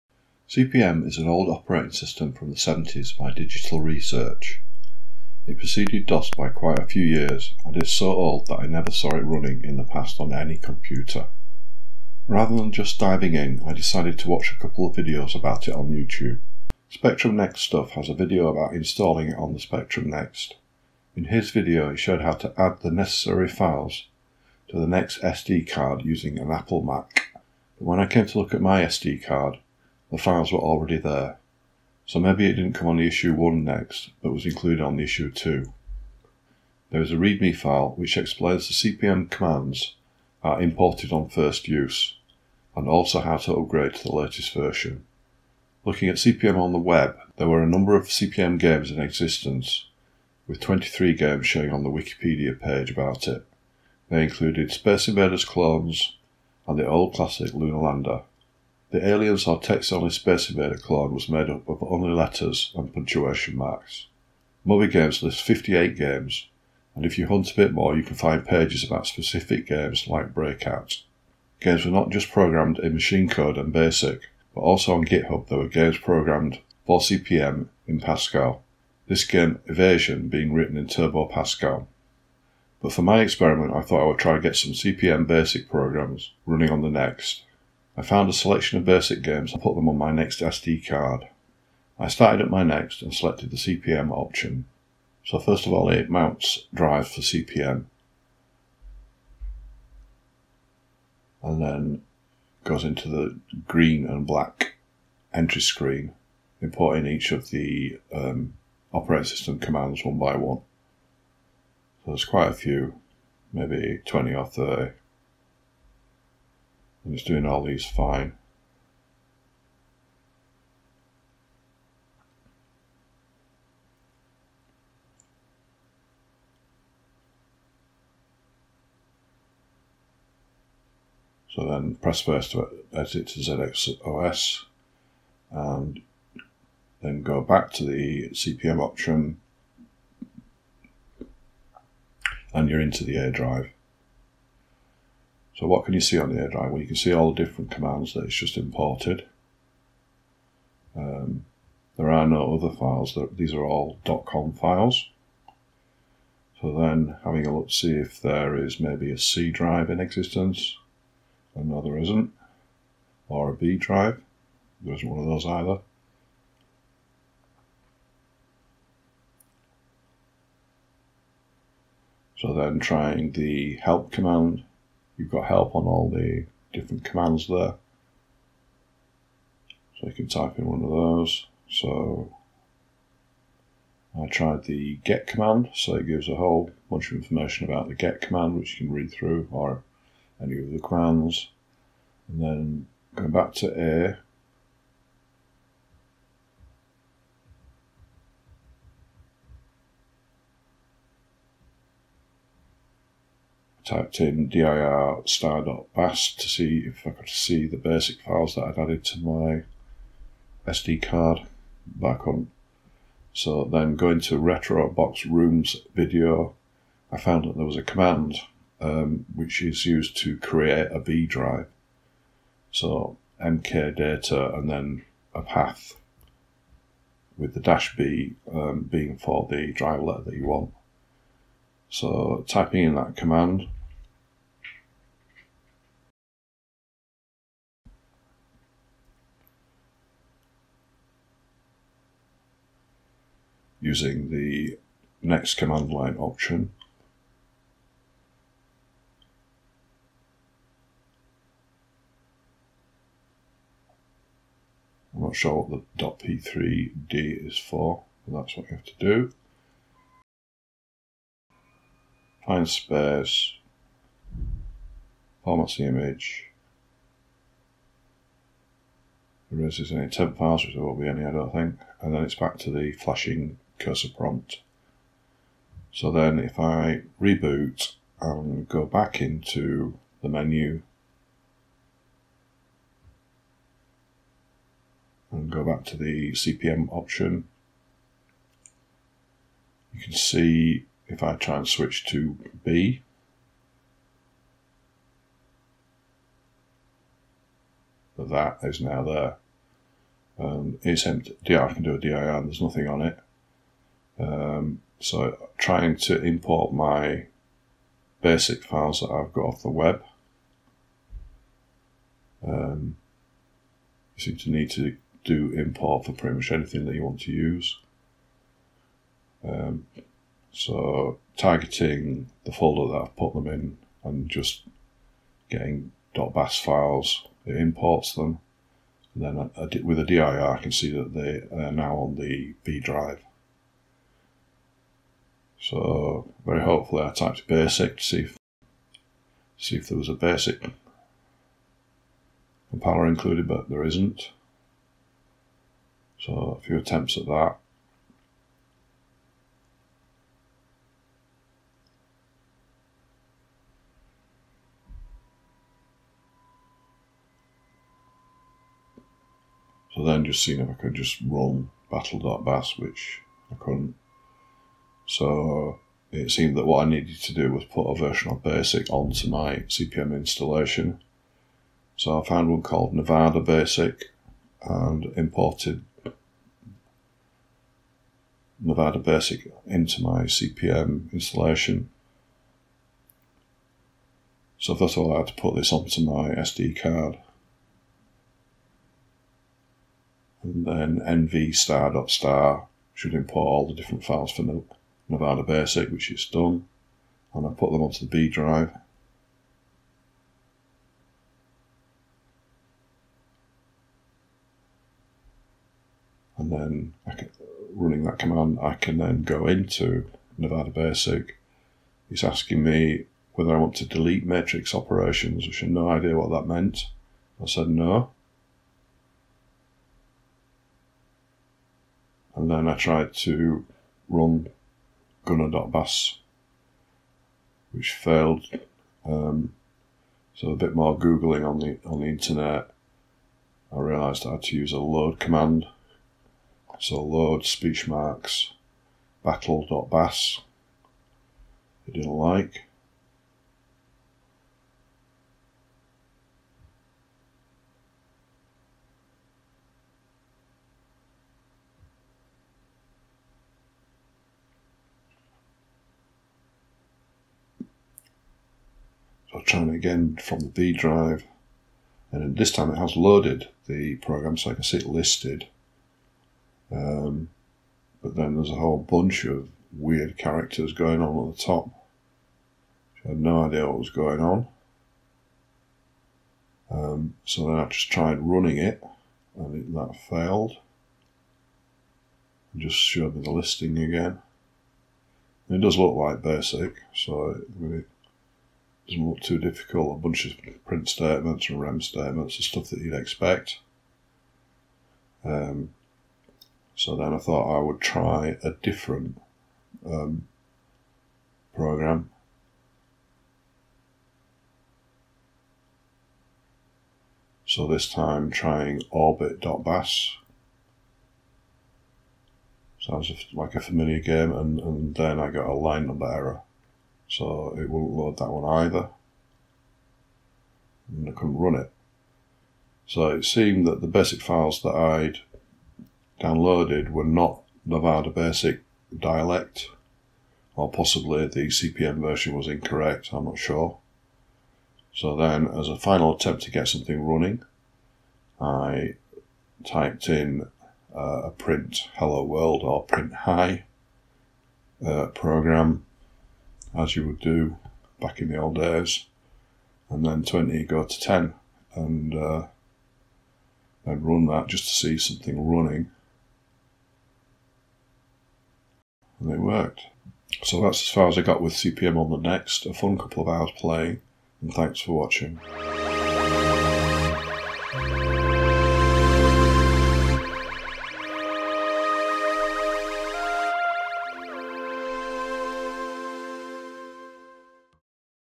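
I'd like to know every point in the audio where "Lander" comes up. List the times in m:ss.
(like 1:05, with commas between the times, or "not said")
0:57.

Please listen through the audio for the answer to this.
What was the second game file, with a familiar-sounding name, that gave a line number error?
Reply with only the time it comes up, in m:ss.
8:28.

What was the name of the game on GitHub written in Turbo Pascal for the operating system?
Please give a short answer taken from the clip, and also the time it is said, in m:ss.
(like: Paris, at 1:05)
Evasion, at 1:19.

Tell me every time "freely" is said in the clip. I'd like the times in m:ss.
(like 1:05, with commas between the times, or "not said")
not said.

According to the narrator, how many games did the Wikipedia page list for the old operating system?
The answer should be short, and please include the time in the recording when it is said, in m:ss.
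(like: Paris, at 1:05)
23, at 0:50.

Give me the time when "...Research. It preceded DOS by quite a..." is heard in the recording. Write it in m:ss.
0:03.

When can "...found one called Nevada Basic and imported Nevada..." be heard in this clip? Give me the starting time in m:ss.
6:12.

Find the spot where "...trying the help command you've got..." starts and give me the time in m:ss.
2:52.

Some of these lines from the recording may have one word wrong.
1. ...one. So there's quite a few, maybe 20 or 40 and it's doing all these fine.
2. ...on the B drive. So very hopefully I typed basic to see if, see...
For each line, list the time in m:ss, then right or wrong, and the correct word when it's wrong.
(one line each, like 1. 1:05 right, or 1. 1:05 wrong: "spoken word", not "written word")
1. 1:50 wrong: "30", not "40"
2. 5:31 right.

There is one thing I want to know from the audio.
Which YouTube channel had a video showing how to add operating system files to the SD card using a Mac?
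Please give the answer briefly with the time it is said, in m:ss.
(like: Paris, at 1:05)
Spectrum Next Stuff, at 0:16.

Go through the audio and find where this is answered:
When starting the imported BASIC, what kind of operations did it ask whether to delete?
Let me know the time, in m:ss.
6:54.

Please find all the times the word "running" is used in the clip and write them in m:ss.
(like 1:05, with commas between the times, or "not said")
0:09, 1:26, 6:47, 7:58, 8:57, 9:15.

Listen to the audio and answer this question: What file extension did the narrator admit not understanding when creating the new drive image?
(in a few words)
.p3d.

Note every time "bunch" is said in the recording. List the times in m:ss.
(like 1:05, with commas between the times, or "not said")
3:06, 7:48, 8:10.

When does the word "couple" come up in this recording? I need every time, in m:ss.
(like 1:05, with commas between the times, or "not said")
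0:14, 9:22.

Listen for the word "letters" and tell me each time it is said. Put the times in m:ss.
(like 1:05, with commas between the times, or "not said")
1:02, 3:50.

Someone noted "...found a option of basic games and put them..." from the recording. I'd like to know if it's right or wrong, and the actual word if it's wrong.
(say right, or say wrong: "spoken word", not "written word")
wrong: "selection", not "option".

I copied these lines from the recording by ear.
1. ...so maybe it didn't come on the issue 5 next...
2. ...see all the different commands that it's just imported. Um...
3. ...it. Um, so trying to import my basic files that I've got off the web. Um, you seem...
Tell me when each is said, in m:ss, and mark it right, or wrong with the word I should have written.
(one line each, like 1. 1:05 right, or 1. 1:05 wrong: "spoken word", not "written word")
1. 0:32 wrong: "1", not "5"
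2. 2:26 right
3. 5:03 right.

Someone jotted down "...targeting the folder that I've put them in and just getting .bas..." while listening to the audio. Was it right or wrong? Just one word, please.
right.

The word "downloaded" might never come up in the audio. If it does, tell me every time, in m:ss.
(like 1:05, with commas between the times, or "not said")
8:46.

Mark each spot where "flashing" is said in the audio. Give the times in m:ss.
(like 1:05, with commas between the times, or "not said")
4:32.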